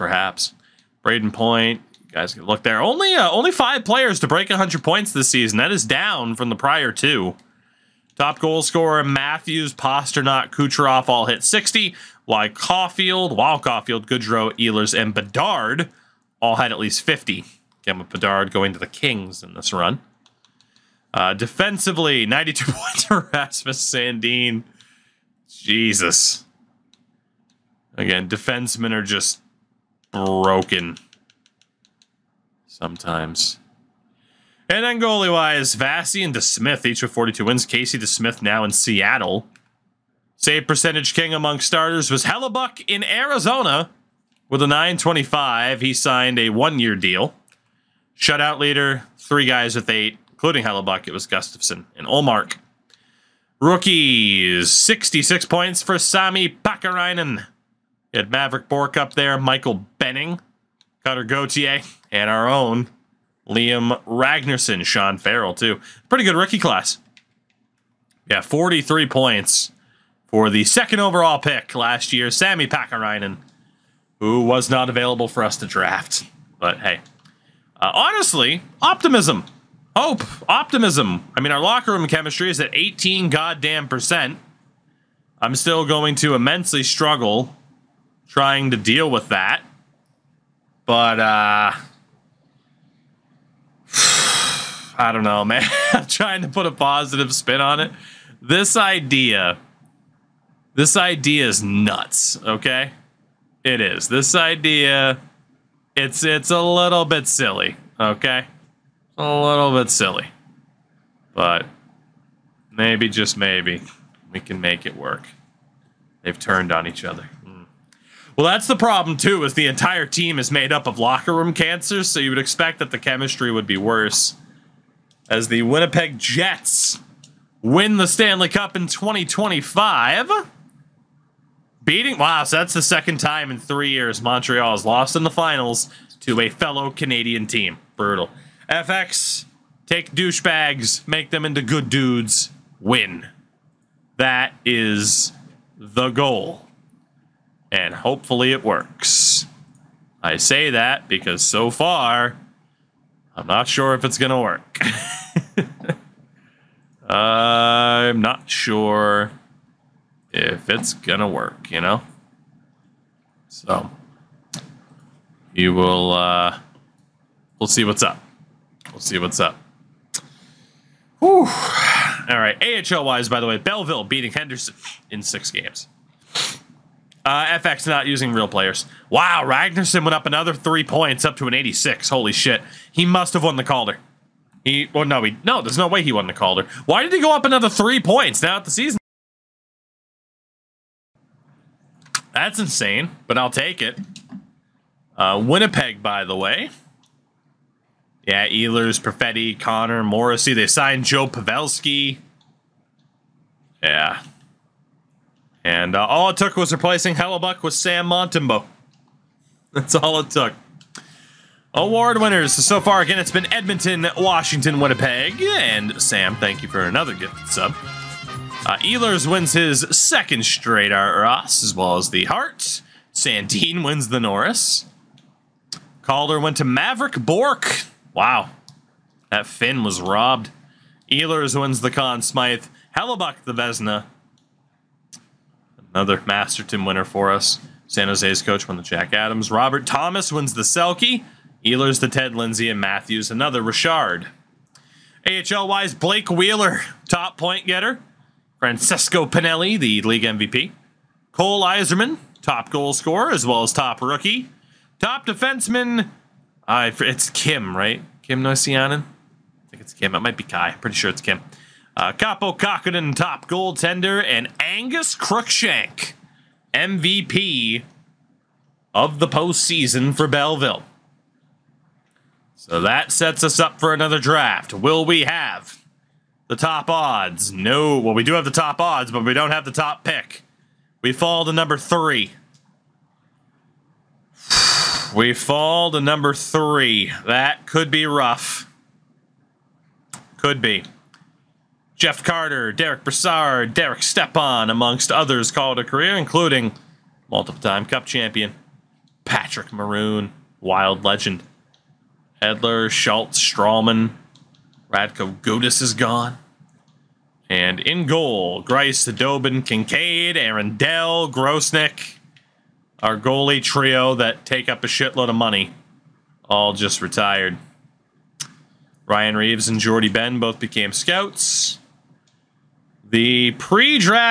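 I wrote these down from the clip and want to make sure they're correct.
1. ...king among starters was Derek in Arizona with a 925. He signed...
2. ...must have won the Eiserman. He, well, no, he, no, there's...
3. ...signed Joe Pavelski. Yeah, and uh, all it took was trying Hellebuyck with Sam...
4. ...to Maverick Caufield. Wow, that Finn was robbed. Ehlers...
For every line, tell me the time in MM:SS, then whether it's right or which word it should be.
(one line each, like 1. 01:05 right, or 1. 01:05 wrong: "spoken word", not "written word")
1. 00:41 wrong: "Hellebuyck", not "Derek"
2. 03:03 wrong: "Calder", not "Eiserman"
3. 03:20 wrong: "replacing", not "trying"
4. 03:46 wrong: "Bourque", not "Caufield".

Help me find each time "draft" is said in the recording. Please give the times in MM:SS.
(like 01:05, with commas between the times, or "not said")
01:15, 04:34, 05:23.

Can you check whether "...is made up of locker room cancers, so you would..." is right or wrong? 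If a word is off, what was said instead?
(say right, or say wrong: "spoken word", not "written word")
right.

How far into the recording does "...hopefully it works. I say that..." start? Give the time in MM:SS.
02:27.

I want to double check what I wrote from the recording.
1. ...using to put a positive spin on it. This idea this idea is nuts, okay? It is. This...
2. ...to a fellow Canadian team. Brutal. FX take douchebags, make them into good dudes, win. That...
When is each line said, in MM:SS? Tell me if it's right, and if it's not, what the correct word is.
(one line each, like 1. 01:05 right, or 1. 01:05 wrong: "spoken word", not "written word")
1. 01:36 wrong: "trying", not "using"
2. 02:16 right.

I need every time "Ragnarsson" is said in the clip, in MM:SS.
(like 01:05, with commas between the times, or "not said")
01:04, 02:59.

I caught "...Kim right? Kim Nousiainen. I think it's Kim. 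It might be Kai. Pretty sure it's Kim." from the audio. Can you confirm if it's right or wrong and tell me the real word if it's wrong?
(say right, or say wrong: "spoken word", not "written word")
right.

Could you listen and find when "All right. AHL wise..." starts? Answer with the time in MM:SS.
02:52.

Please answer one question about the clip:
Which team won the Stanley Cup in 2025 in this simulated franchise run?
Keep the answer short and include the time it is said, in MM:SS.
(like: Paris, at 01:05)
Winnipeg Jets, at 02:05.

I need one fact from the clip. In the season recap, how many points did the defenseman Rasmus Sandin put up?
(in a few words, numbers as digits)
92.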